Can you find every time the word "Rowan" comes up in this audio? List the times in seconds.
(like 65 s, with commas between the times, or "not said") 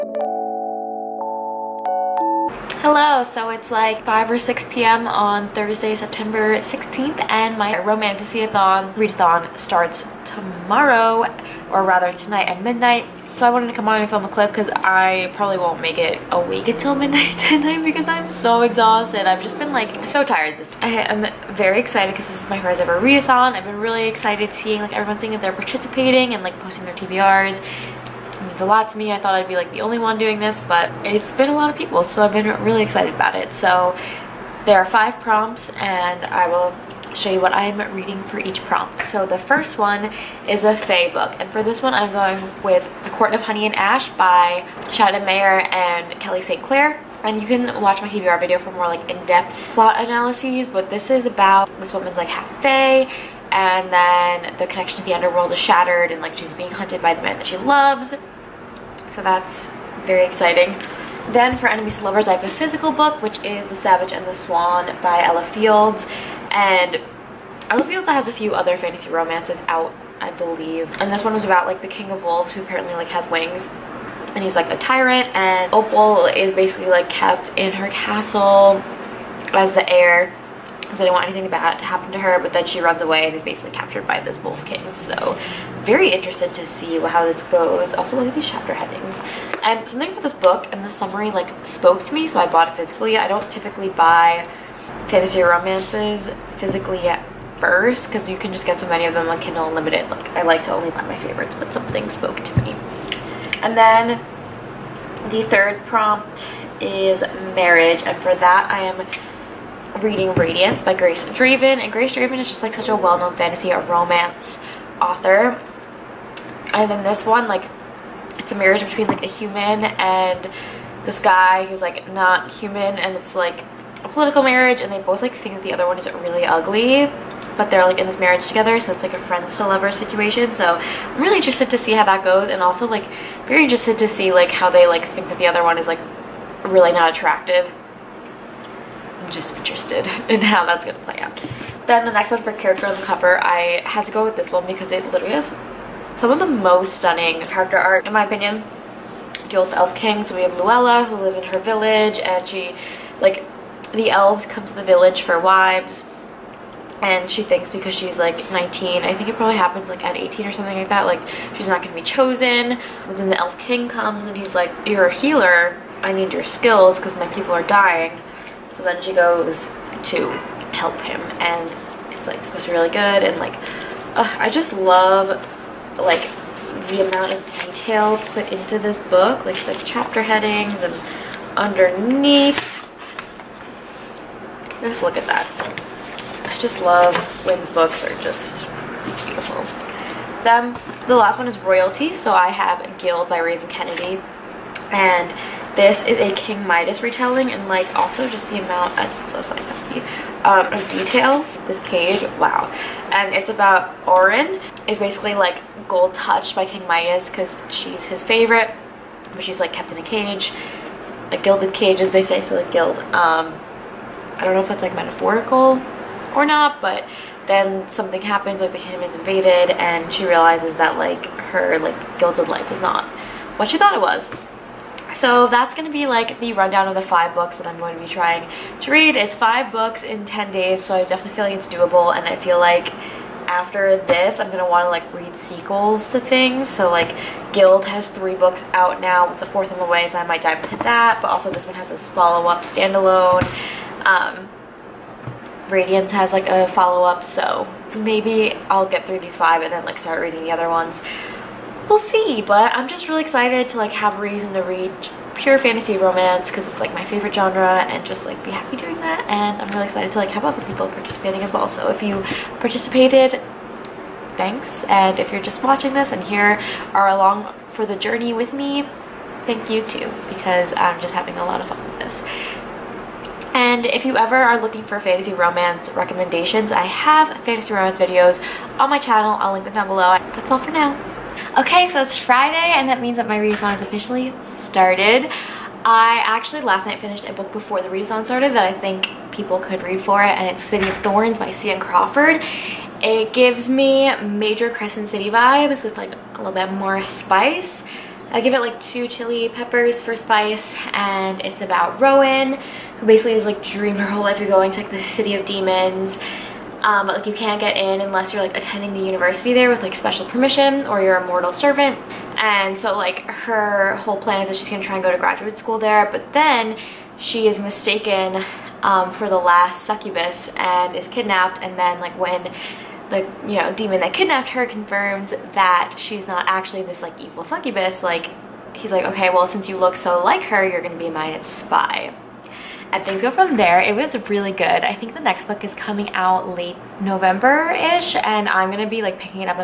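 301 s.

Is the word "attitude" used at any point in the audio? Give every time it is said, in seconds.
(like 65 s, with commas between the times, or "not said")
not said.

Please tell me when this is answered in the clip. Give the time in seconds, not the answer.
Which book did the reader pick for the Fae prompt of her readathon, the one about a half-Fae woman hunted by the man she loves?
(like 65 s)
43 s.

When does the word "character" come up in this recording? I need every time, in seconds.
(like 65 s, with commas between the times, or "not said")
142 s, 147 s.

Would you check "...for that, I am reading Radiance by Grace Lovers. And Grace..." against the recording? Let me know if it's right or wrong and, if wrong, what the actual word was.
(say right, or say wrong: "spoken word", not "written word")
wrong: "Draven", not "Lovers".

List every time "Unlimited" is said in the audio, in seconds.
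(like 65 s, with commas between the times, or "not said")
99 s.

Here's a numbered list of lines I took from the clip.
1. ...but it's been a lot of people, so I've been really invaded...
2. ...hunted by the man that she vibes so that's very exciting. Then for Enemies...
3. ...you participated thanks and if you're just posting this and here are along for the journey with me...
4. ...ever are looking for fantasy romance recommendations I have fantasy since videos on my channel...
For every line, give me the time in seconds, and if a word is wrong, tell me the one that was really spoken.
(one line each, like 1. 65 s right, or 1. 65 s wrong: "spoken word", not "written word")
1. 30 s wrong: "excited", not "invaded"
2. 56 s wrong: "loves", not "vibes"
3. 262 s wrong: "watching", not "posting"
4. 274 s wrong: "romance", not "since".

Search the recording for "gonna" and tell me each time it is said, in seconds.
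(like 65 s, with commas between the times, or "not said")
140 s, 161 s, 234 s, 314 s, 330 s, 338 s.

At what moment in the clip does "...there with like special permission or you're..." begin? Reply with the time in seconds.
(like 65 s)
309 s.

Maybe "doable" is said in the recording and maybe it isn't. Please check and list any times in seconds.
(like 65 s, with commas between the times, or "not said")
231 s.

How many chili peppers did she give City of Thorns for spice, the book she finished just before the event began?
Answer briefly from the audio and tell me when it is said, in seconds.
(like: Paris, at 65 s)
2, at 298 s.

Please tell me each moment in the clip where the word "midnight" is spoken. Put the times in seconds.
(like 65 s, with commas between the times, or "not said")
12 s, 17 s.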